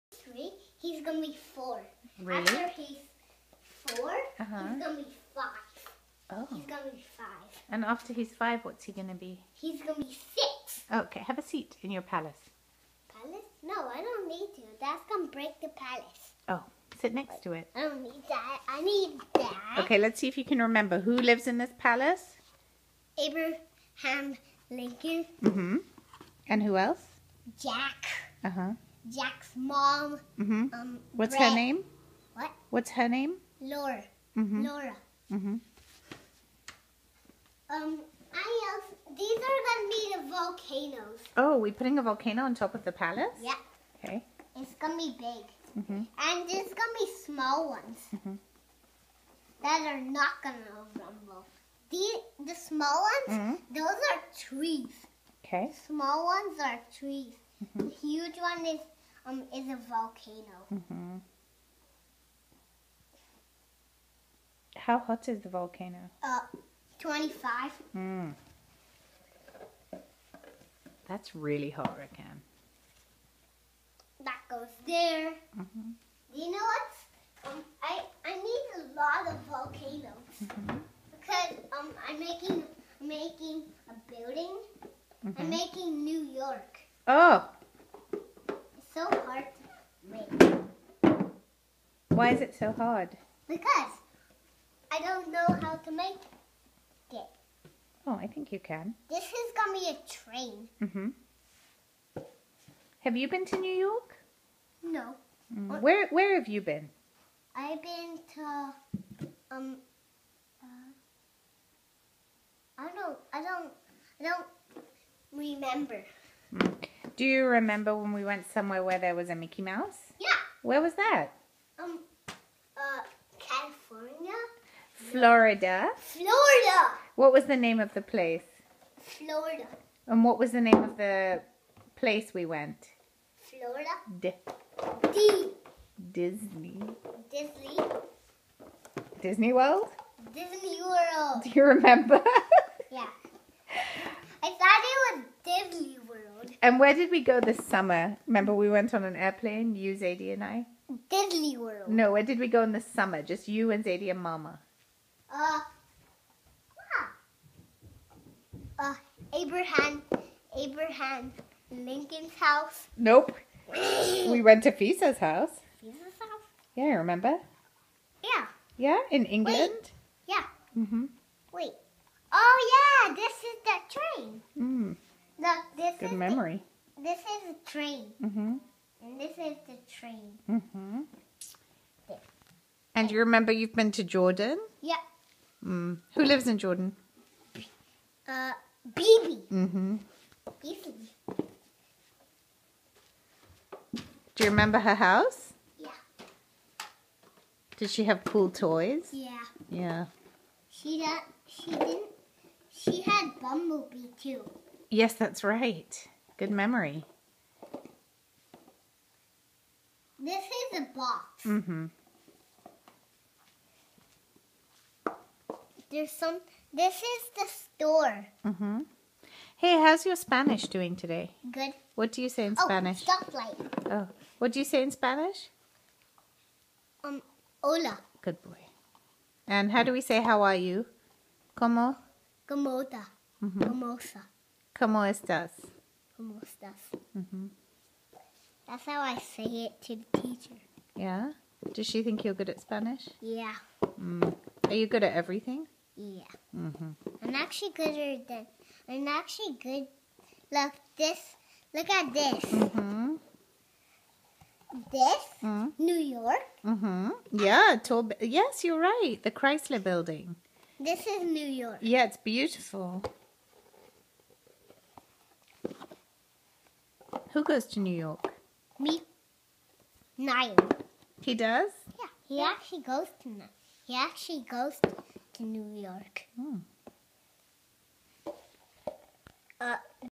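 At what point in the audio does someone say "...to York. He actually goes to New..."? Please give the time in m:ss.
4:33.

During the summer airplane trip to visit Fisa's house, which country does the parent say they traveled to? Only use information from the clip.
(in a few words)
England.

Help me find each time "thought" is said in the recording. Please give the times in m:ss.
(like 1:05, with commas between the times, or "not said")
2:24.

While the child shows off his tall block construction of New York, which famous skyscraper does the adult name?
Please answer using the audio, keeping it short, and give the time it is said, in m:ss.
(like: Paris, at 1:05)
Chrysler Building, at 4:19.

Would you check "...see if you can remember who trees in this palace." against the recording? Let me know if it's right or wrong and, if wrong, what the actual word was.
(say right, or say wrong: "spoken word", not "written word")
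wrong: "lives", not "trees".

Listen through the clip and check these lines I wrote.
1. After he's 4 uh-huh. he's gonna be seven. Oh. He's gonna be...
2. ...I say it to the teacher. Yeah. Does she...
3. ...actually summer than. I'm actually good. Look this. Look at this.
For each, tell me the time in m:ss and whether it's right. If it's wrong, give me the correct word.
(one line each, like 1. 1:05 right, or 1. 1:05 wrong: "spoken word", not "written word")
1. 0:02 wrong: "five", not "seven"
2. 3:59 right
3. 4:07 wrong: "gooder", not "summer".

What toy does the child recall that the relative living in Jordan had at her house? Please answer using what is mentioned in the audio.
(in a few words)
Bumblebee.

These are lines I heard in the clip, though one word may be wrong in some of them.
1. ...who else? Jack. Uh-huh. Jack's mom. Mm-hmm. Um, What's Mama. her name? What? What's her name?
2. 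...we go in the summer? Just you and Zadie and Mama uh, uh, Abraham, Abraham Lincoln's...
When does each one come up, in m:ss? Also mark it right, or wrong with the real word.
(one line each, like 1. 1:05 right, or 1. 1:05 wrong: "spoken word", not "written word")
1. 0:26 wrong: "Brett", not "Mama"
2. 2:32 right.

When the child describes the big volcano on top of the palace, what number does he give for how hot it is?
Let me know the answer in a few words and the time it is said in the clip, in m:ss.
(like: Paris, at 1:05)
25, at 1:06.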